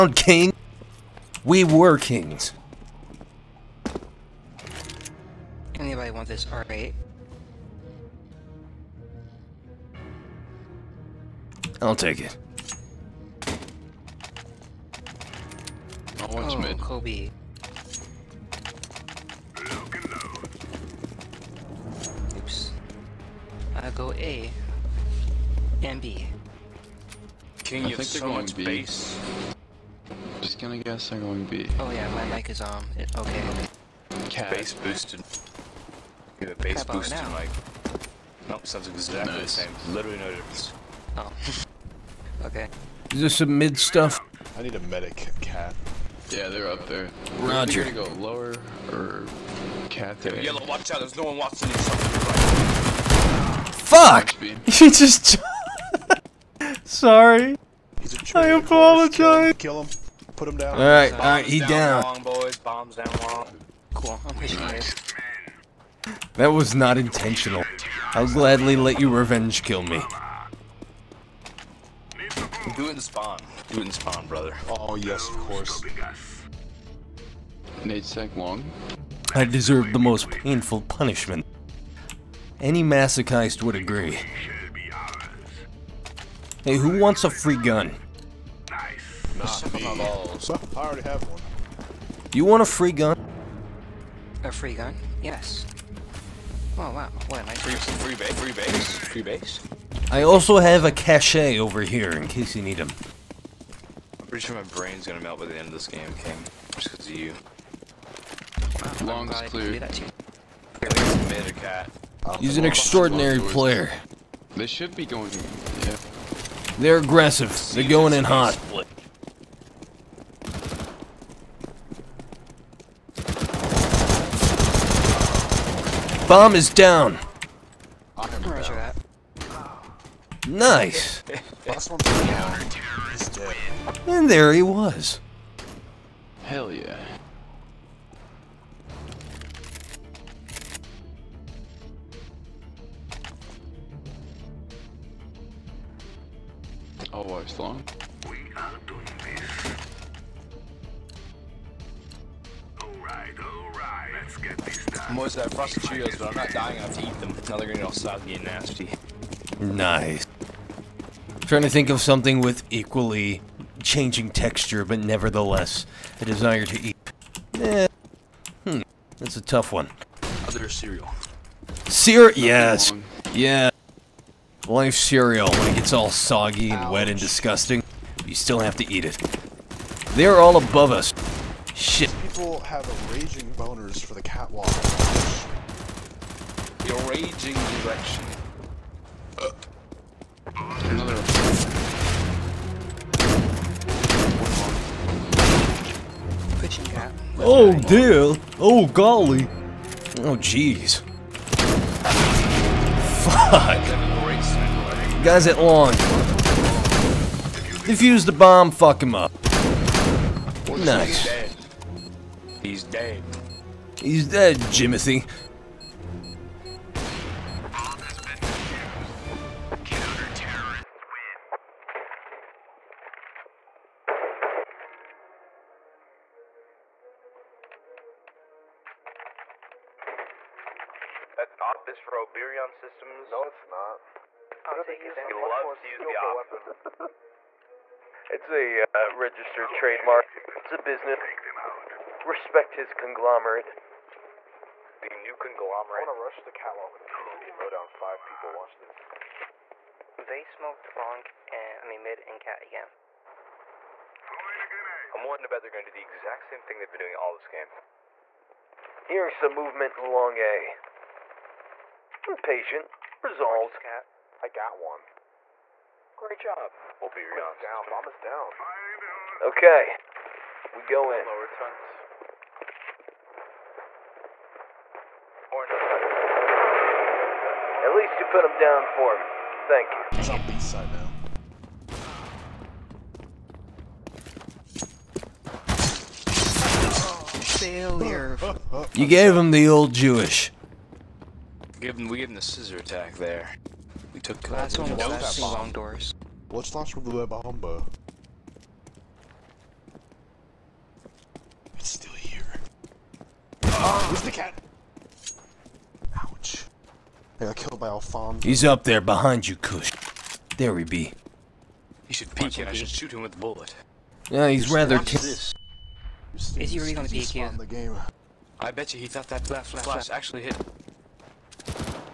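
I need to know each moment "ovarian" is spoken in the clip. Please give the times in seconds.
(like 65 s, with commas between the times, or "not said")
not said.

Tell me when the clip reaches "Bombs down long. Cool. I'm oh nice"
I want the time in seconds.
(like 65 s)
62 s.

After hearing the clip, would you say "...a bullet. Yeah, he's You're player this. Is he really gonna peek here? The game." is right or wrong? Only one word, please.
wrong.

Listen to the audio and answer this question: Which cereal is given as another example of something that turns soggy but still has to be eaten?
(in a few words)
Life cereal.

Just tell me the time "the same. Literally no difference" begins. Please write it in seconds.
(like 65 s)
39 s.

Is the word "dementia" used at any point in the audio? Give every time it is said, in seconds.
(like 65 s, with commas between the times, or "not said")
not said.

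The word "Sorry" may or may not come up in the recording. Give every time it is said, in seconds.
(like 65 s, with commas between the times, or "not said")
56 s.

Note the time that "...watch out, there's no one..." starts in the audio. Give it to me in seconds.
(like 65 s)
50 s.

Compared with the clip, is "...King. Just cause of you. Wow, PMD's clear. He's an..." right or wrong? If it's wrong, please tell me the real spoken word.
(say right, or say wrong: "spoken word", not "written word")
wrong: "Long", not "PMD".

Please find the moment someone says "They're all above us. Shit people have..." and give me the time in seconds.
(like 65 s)
180 s.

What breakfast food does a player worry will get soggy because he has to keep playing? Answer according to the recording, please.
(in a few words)
Cheerios.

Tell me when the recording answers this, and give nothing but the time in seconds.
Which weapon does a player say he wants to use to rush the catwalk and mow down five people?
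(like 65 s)
247 s.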